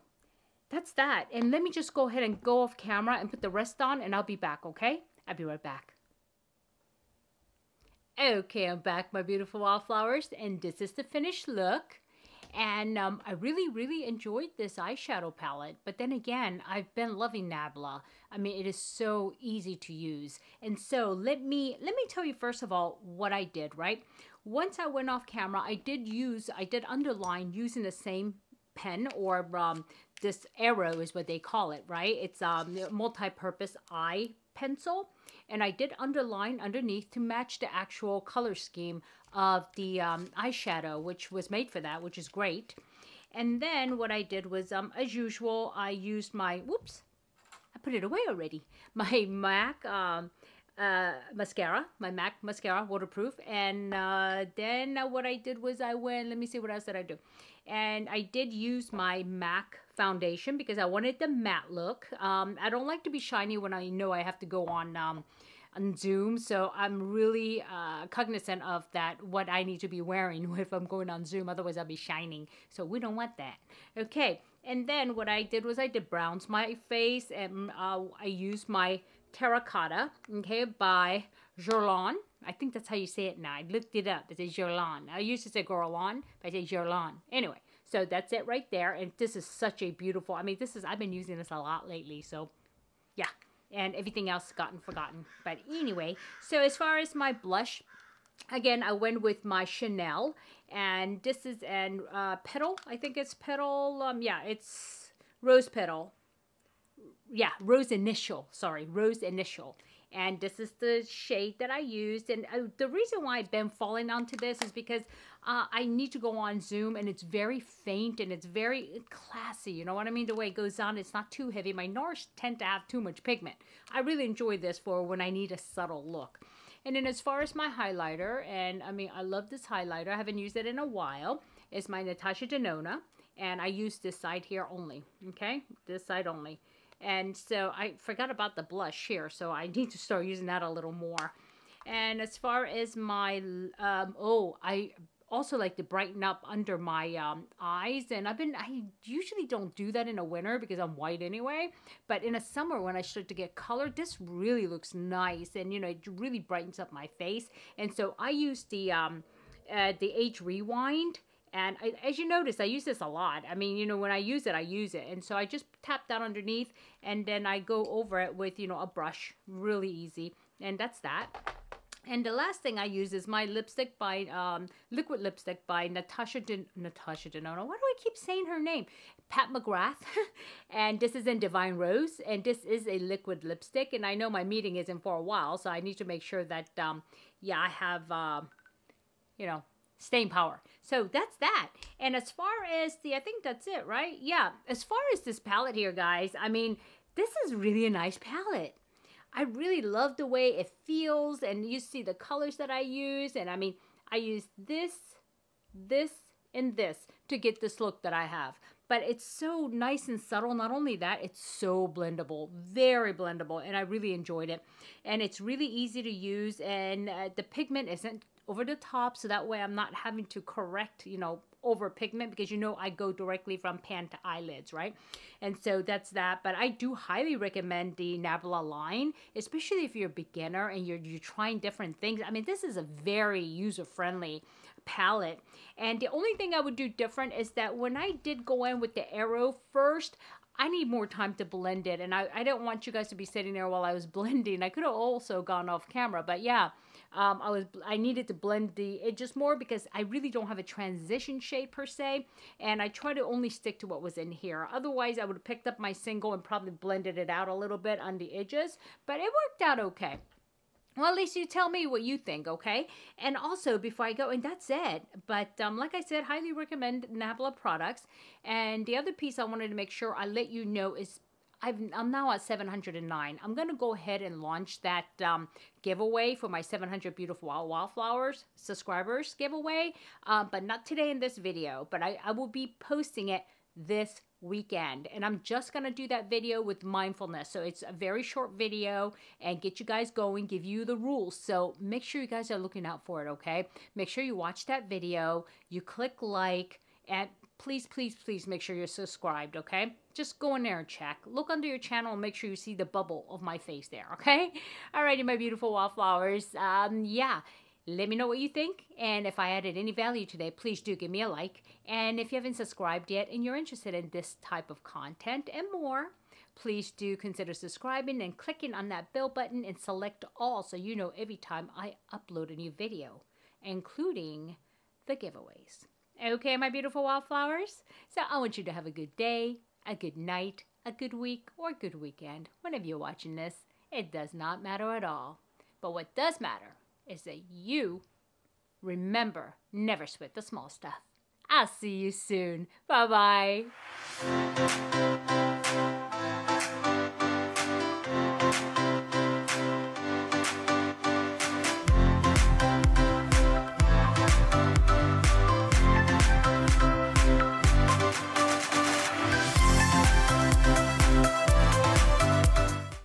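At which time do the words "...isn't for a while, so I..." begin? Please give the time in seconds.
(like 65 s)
184 s.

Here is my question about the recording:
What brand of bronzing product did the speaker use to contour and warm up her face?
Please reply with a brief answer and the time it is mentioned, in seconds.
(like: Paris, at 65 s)
Terracotta, at 79 s.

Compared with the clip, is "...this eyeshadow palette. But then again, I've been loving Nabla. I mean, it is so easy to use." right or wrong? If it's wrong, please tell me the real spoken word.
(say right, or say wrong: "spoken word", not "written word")
right.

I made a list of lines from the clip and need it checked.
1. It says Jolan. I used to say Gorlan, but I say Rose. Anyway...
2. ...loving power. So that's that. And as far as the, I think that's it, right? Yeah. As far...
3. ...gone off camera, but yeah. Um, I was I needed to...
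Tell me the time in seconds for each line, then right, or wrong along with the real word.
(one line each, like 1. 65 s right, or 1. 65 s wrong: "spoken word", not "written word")
1. 84 s wrong: "Jolan", not "Rose"
2. 190 s wrong: "staying", not "loving"
3. 245 s right.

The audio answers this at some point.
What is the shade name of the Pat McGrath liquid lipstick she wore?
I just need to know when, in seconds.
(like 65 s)
181 s.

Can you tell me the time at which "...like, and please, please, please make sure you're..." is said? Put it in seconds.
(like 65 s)
296 s.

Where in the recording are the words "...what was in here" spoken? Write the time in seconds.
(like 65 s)
253 s.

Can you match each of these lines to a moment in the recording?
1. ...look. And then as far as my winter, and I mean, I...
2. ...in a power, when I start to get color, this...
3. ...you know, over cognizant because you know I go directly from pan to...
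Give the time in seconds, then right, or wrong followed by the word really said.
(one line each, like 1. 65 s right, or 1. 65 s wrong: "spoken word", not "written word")
1. 126 s wrong: "highlighter", not "winter"
2. 152 s wrong: "summer", not "power"
3. 221 s wrong: "pigment", not "cognizant".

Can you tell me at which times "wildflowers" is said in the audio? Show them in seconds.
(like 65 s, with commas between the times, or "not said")
277 s, 327 s.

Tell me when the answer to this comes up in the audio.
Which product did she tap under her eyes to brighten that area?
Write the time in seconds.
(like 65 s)
160 s.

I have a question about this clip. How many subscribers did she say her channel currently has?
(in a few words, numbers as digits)
709.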